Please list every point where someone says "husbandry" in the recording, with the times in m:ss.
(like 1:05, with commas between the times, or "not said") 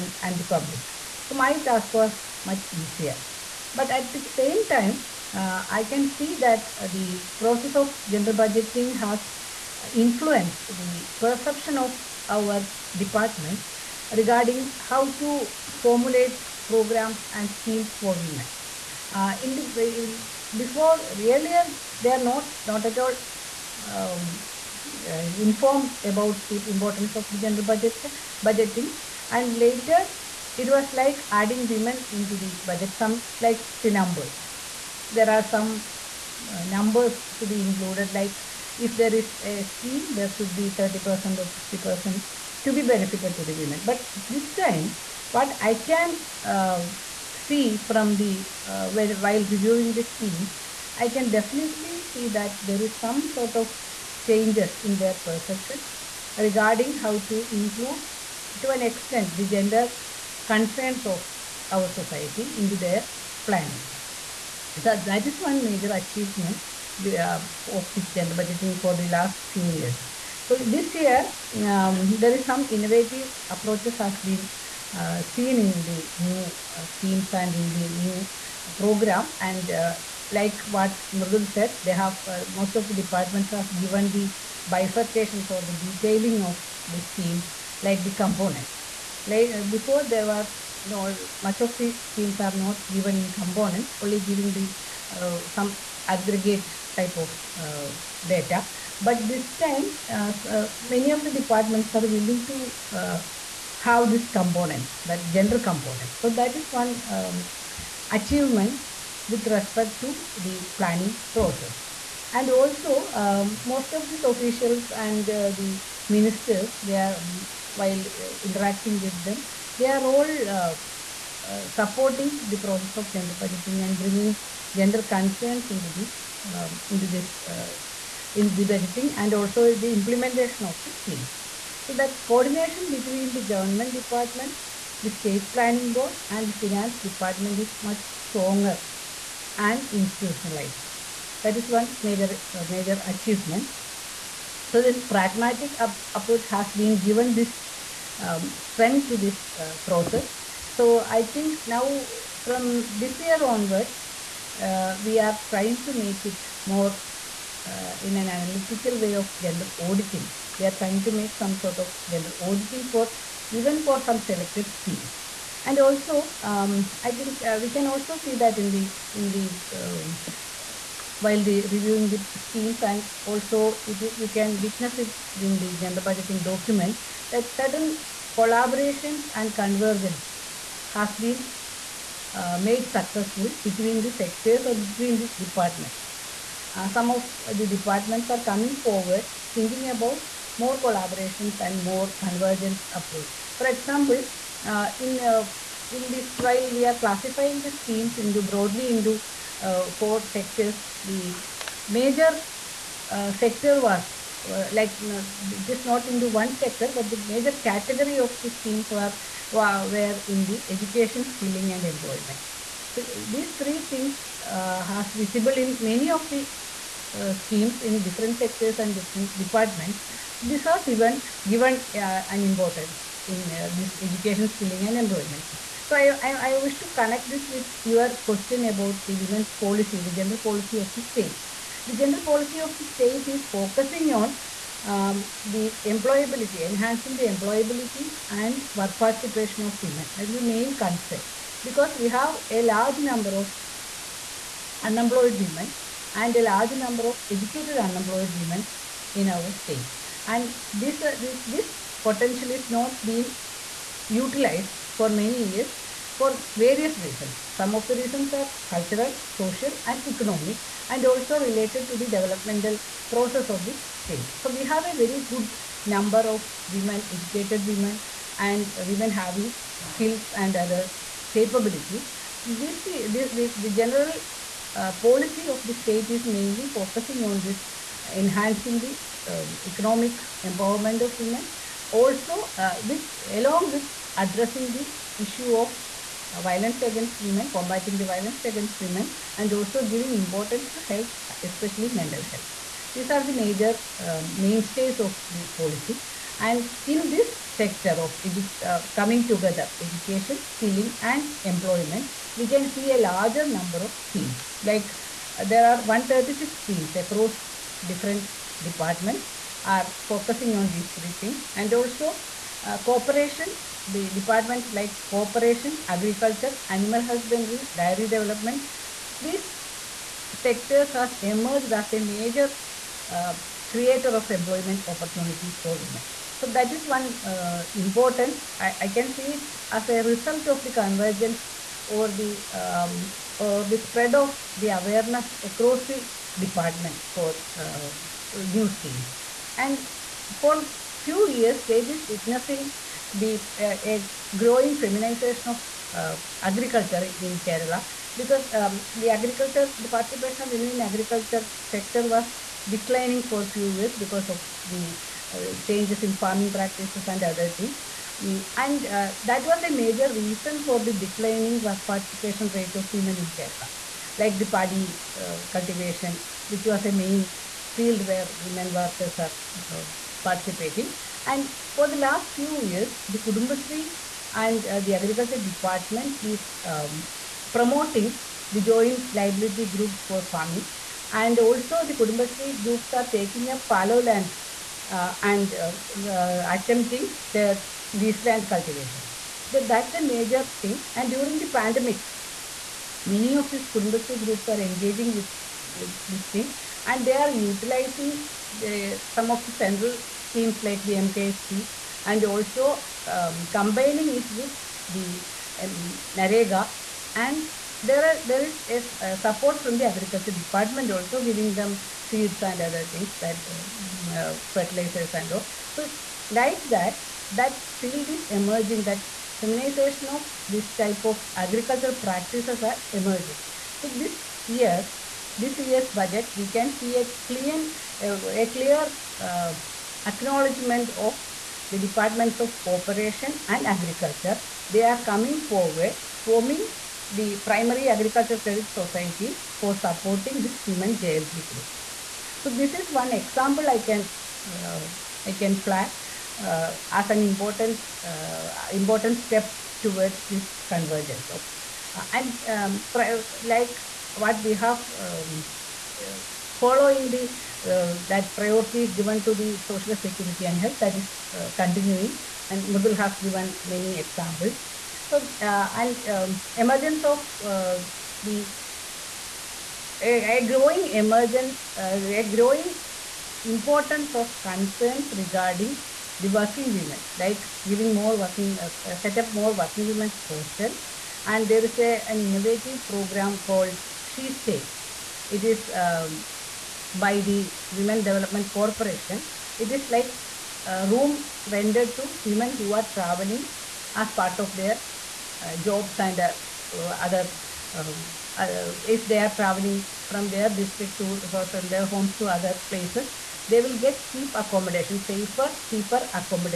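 5:17.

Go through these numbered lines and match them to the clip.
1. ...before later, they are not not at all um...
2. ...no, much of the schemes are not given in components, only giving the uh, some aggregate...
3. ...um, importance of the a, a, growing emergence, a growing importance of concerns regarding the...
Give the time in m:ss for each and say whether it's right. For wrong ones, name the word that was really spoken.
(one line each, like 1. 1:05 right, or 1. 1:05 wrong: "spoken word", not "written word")
1. 0:20 wrong: "earlier", not "later"
2. 1:30 right
3. 7:46 wrong: "emergence", not "importance".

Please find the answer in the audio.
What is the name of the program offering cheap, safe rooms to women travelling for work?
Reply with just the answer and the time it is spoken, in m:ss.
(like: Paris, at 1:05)
She Stay, at 8:04.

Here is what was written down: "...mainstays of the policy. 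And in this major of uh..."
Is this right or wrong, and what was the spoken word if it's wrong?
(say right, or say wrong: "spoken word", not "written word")
wrong: "sector", not "major".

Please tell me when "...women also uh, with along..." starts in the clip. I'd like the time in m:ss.
4:41.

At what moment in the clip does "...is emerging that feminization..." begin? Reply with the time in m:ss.
6:58.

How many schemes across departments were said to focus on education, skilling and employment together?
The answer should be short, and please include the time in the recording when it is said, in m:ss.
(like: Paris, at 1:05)
136, at 5:05.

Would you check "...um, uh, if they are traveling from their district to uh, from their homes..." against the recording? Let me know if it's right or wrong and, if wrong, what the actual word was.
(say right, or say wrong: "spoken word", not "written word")
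right.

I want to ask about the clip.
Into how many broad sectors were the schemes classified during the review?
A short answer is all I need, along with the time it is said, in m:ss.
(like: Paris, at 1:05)
4, at 3:19.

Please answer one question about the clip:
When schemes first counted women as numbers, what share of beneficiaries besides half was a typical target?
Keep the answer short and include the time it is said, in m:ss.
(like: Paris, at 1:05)
30%, at 0:40.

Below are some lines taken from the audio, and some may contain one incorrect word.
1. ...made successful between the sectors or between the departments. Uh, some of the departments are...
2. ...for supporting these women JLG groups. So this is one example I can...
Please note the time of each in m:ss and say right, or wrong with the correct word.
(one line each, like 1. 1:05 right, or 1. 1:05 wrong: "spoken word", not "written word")
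1. 3:02 right
2. 7:19 right.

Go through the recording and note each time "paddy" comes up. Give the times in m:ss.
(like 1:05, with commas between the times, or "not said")
6:04.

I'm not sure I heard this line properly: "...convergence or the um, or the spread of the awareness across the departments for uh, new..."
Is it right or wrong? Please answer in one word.
right.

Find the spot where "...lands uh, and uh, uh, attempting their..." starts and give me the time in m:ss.
6:24.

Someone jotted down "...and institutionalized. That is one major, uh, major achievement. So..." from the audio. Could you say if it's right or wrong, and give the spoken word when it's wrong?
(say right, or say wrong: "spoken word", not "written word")
right.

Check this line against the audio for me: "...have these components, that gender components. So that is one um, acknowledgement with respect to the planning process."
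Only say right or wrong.
wrong.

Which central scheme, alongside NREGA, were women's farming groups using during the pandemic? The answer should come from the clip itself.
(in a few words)
MKSP.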